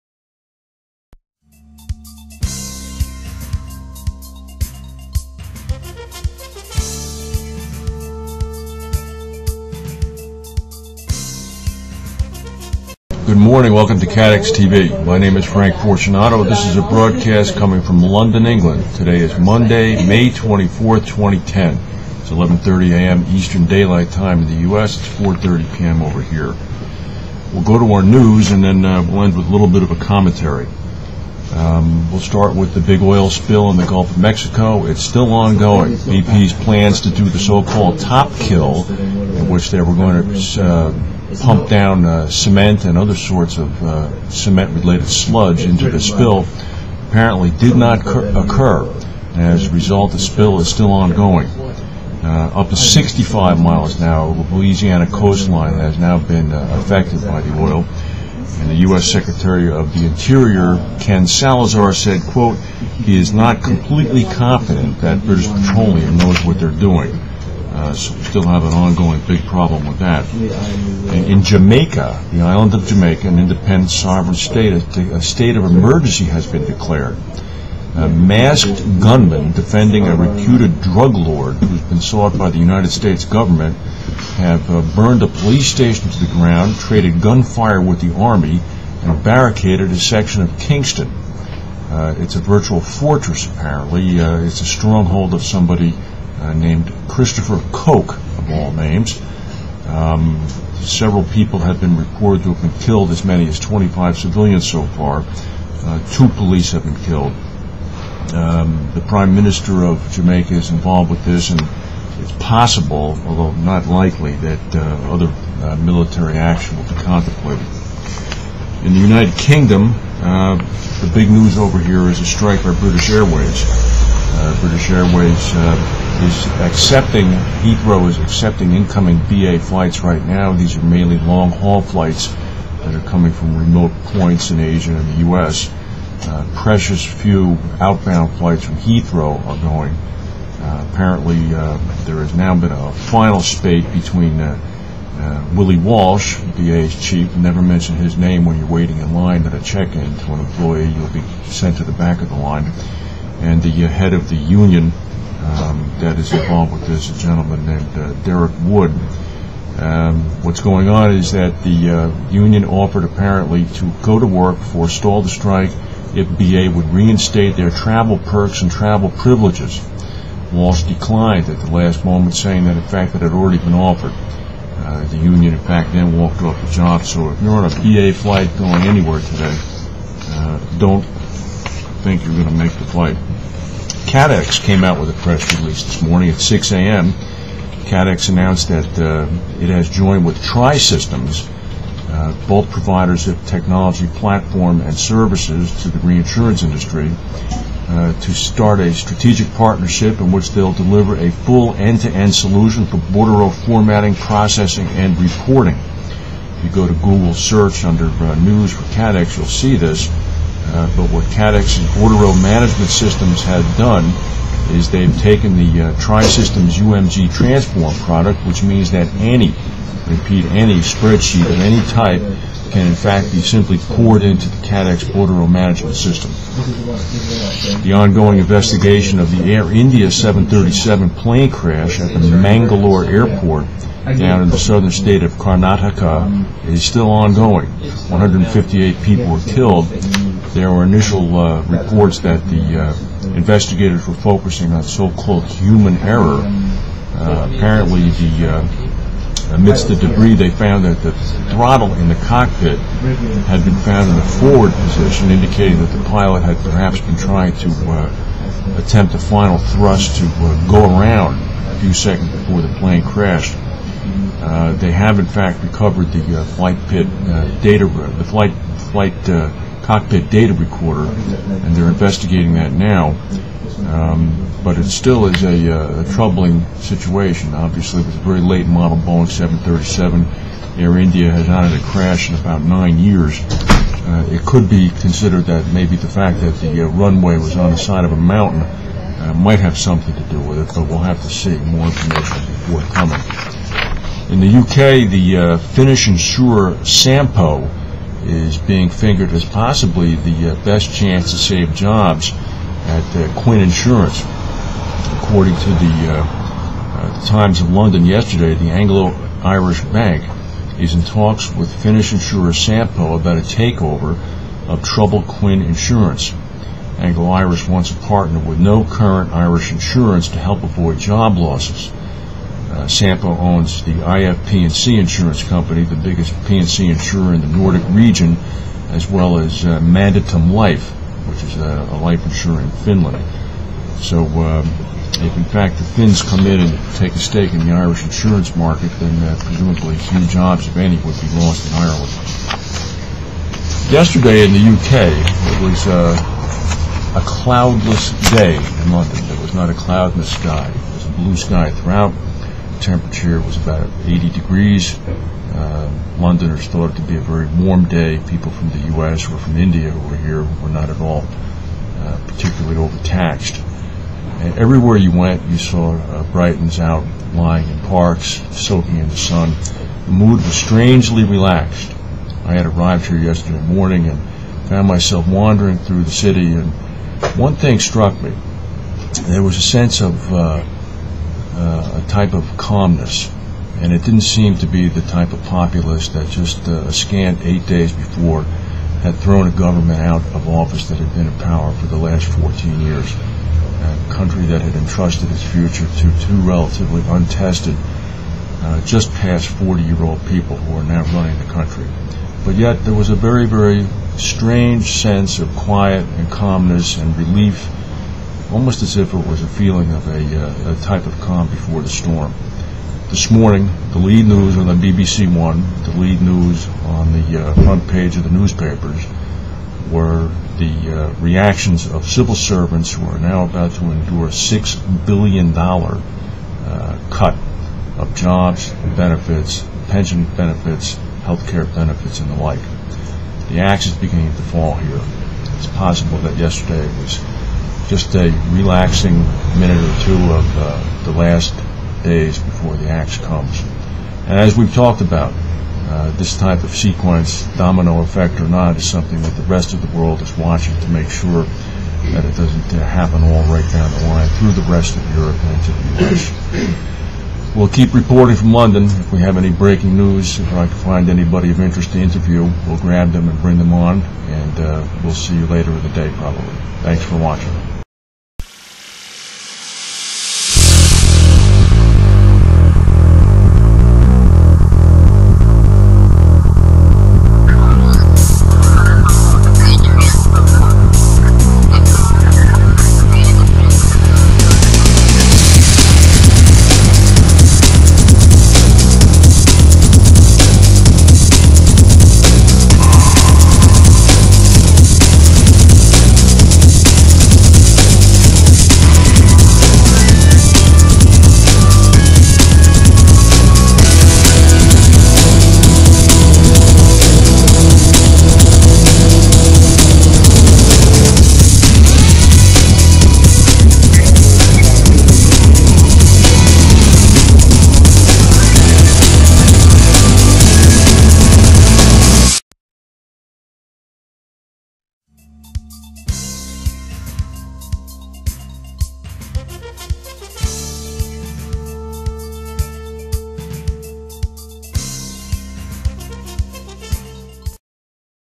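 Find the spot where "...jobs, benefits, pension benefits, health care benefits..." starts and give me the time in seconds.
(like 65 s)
428 s.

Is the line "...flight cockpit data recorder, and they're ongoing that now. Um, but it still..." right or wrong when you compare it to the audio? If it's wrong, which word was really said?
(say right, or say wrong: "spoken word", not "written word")
wrong: "investigating", not "ongoing".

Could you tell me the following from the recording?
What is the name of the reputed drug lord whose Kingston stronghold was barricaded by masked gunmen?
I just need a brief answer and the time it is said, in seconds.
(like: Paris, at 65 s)
Christopher Coke, at 97 s.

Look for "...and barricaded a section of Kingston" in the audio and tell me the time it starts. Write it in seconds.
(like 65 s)
89 s.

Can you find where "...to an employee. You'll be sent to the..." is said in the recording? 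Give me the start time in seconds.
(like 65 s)
150 s.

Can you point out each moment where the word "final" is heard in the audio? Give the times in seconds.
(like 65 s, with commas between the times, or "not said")
142 s, 259 s.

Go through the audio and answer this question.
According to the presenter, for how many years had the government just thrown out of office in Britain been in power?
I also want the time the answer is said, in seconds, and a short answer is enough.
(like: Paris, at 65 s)
14 years, at 392 s.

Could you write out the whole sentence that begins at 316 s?
Anglo-Irish wants a partner with no current Irish insurance to help avoid job losses.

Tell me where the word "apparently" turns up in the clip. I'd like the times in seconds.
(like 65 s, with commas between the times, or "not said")
47 s, 93 s, 140 s, 163 s, 247 s.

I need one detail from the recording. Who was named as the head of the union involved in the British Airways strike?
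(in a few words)
Derek Wood.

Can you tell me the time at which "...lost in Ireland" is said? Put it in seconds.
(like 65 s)
341 s.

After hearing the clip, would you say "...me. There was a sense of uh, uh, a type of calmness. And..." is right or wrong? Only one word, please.
right.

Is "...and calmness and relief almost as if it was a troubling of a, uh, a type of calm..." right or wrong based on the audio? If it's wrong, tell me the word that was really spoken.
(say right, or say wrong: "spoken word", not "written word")
wrong: "feeling", not "troubling".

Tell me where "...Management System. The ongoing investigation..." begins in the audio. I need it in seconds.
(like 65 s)
225 s.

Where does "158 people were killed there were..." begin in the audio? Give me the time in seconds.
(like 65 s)
238 s.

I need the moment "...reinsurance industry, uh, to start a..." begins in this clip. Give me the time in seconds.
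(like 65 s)
195 s.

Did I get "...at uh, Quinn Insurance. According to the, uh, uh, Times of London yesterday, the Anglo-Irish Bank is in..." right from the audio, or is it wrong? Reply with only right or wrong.
right.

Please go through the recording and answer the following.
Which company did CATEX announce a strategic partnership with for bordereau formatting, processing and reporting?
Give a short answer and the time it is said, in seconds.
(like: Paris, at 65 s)
Tri Systems, at 190 s.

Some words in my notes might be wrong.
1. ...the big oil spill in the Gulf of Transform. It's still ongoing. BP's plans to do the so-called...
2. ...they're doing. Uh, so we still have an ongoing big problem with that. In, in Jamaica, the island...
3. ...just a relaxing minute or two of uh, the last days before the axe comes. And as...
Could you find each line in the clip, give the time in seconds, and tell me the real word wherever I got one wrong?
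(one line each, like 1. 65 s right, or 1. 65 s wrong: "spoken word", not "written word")
1. 32 s wrong: "Mexico", not "Transform"
2. 66 s right
3. 437 s right.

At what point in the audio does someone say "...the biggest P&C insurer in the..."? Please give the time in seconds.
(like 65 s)
325 s.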